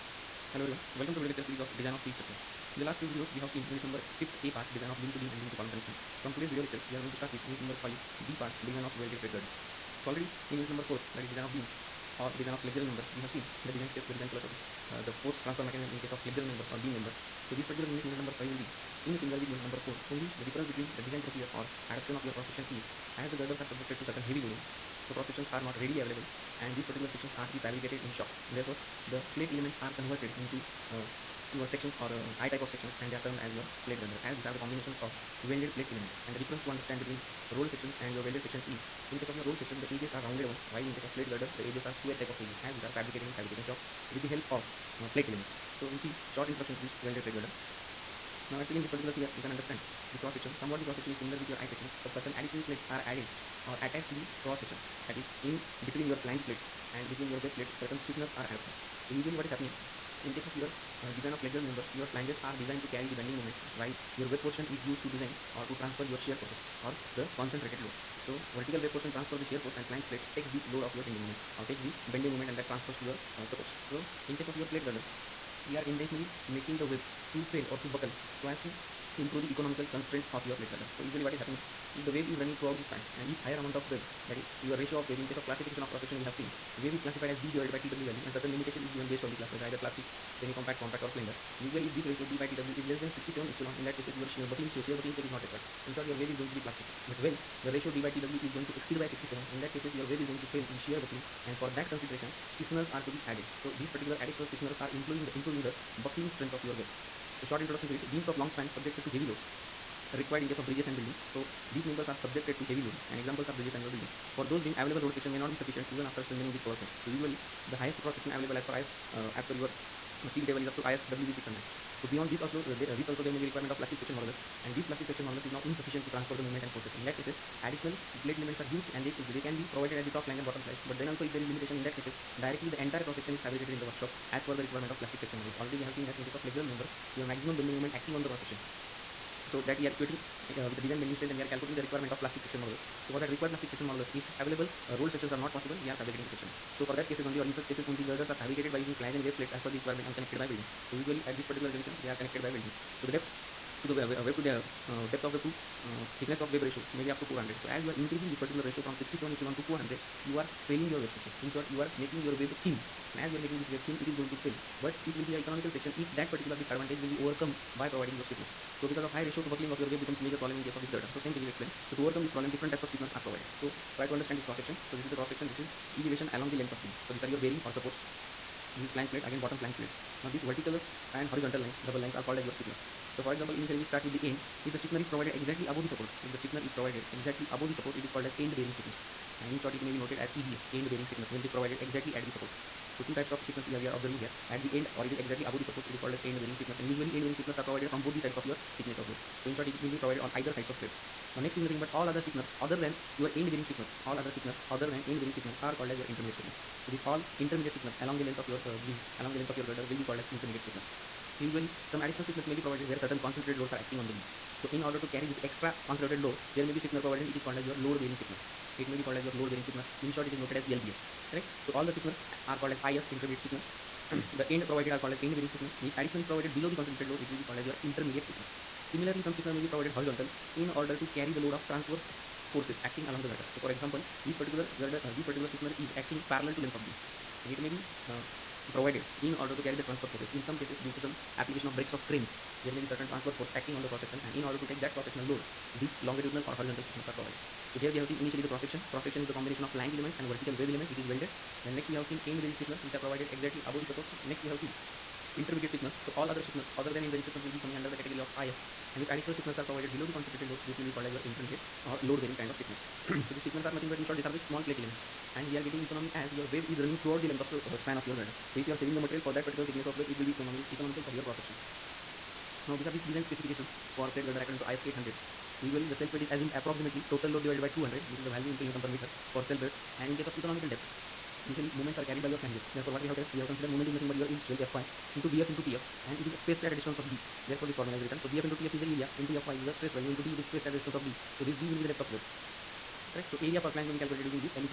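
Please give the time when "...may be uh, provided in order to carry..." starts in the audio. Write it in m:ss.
3:57.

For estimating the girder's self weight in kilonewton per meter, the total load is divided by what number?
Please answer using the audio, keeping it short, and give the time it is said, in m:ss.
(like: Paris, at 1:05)
200, at 4:37.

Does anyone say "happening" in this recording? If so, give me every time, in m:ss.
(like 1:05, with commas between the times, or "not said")
0:59, 1:21.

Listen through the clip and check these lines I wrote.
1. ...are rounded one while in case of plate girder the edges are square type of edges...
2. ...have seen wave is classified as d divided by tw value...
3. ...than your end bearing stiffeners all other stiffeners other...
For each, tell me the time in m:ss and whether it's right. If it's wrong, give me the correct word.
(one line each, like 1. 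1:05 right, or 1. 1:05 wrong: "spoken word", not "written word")
1. 0:40 right
2. 1:26 right
3. 3:22 right.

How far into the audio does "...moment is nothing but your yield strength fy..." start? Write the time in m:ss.
4:43.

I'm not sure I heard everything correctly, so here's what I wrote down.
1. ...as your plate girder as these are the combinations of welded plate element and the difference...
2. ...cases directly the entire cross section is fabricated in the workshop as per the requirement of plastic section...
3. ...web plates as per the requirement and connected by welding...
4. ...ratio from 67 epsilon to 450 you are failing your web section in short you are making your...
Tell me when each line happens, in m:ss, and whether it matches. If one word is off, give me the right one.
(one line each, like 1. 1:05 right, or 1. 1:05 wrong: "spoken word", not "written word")
1. 0:33 right
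2. 2:11 right
3. 2:29 right
4. 2:38 wrong: "400", not "450".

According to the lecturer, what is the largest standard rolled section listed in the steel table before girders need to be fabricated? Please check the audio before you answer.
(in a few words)
ISWB 600.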